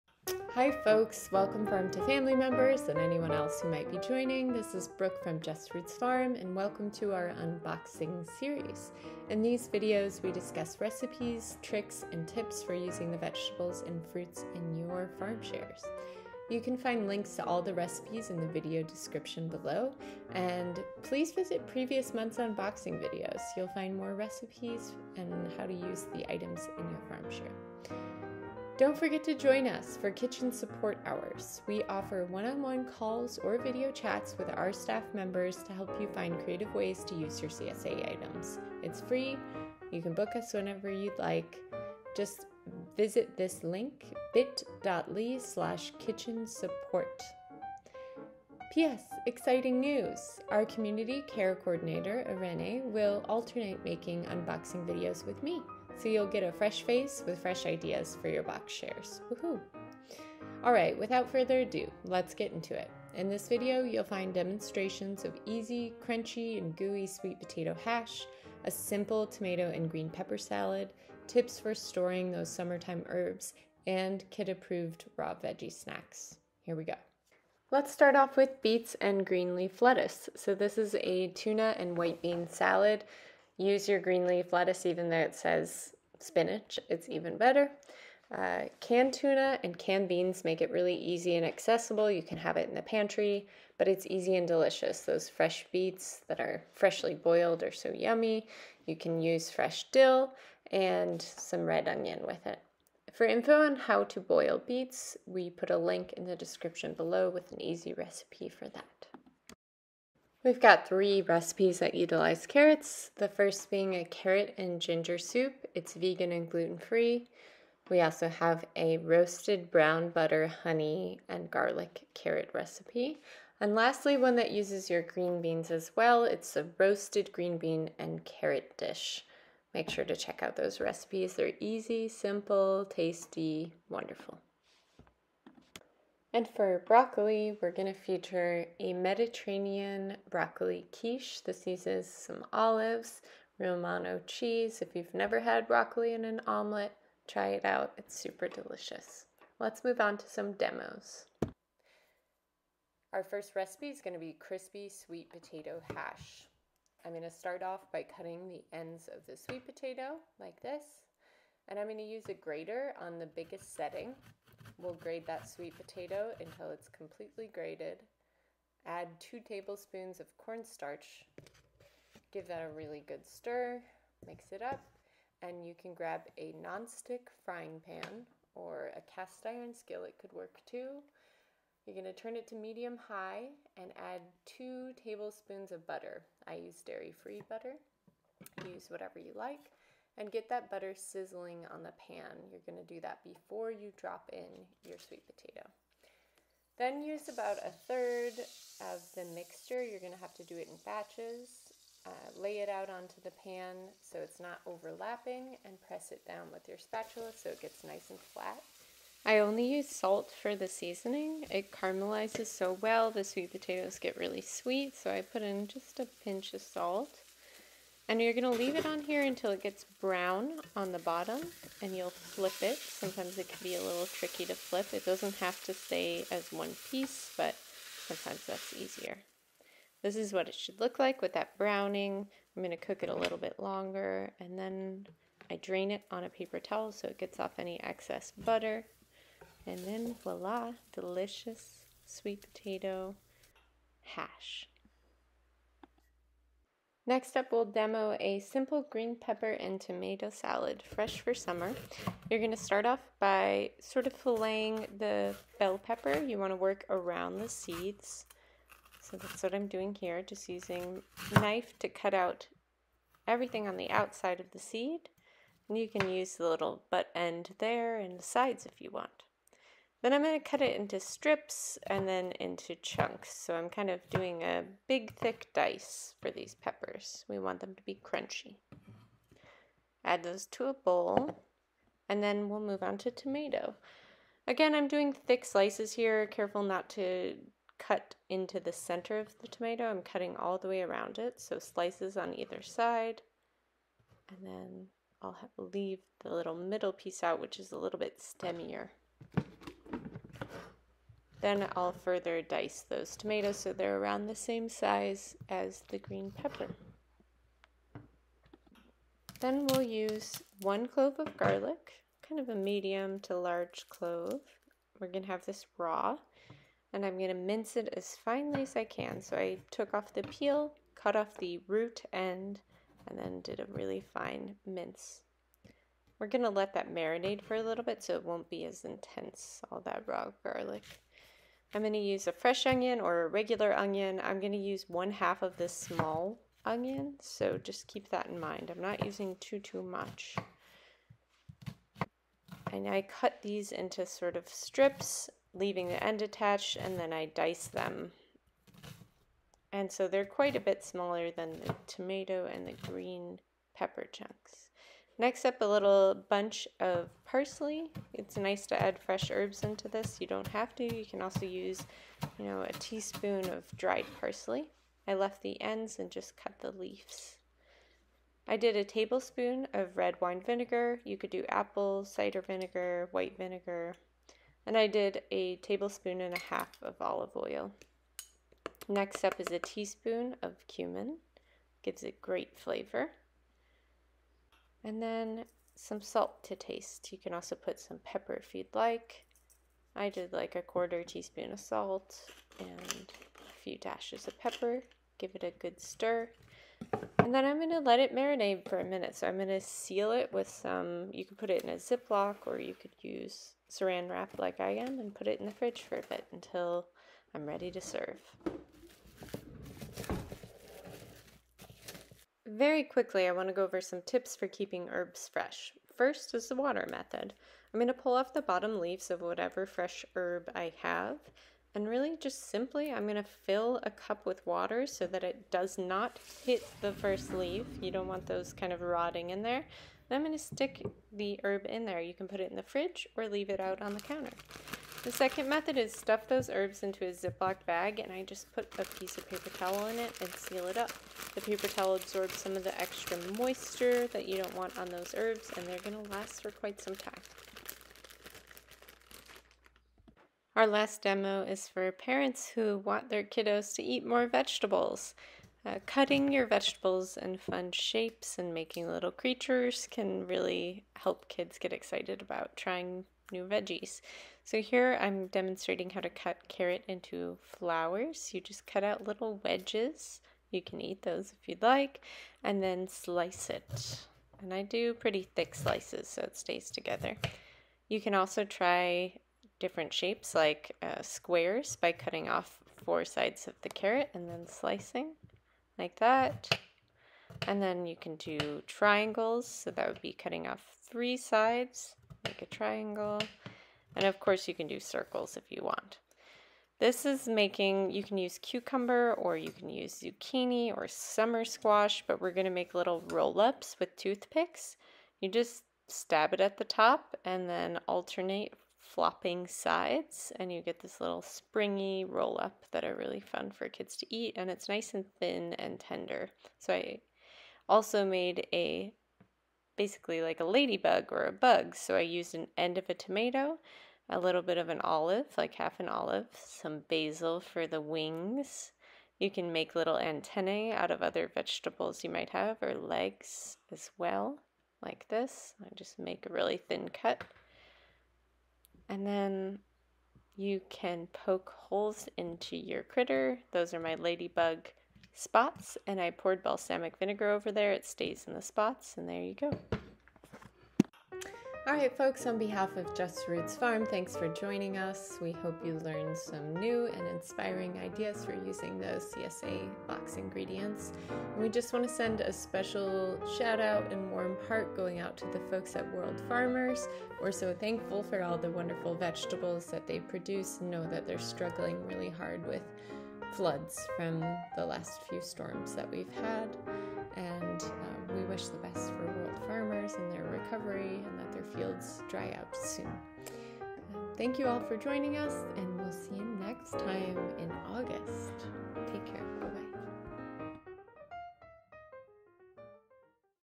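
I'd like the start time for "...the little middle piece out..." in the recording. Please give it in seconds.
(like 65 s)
296 s.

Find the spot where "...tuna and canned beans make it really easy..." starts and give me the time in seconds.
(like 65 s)
89 s.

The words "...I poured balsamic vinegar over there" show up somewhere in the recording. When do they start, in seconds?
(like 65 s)
545 s.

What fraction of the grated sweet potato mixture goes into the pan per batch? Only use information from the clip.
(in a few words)
a third.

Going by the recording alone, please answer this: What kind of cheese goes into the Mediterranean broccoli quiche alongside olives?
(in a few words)
Romano.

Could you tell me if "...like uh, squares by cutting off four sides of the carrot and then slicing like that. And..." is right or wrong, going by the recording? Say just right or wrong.
right.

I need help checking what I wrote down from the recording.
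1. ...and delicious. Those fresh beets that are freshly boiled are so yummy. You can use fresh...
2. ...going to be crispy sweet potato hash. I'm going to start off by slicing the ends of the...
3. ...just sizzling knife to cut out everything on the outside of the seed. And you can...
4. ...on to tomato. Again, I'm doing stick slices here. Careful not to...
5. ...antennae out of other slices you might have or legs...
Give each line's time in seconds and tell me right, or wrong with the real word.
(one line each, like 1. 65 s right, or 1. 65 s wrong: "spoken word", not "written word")
1. 94 s right
2. 154 s wrong: "cutting", not "slicing"
3. 260 s wrong: "using", not "sizzling"
4. 282 s wrong: "thick", not "stick"
5. 529 s wrong: "vegetables", not "slices".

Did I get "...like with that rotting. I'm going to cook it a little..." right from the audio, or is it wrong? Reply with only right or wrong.
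wrong.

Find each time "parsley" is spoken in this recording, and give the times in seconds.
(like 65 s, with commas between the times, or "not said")
357 s, 364 s.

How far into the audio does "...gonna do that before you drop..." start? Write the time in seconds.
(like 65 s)
192 s.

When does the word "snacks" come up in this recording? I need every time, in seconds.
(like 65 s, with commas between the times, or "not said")
75 s.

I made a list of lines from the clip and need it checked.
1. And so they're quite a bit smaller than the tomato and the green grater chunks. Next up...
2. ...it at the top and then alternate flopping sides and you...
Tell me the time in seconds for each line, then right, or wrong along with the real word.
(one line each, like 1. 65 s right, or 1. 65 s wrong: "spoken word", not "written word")
1. 349 s wrong: "pepper", not "grater"
2. 506 s right.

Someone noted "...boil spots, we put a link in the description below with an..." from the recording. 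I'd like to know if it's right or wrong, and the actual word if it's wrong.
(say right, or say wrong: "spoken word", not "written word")
wrong: "beets", not "spots".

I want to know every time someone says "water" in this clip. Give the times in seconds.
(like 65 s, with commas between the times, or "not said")
416 s, 424 s.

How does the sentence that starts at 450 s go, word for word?
Our last demo is for parents who want their kiddos to eat more vegetables.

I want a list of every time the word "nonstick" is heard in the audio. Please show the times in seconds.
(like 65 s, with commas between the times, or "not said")
176 s.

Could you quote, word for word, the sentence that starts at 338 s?
I'm not using too, too much.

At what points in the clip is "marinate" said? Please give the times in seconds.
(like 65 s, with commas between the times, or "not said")
326 s, 398 s.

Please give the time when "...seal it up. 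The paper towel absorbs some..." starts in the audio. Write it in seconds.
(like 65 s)
440 s.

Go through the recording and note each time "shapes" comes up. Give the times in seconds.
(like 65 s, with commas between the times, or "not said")
457 s, 479 s.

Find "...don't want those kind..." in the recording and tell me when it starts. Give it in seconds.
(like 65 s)
427 s.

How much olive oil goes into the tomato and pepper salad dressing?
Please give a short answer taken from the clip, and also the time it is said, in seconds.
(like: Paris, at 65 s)
1.5 tablespoons, at 375 s.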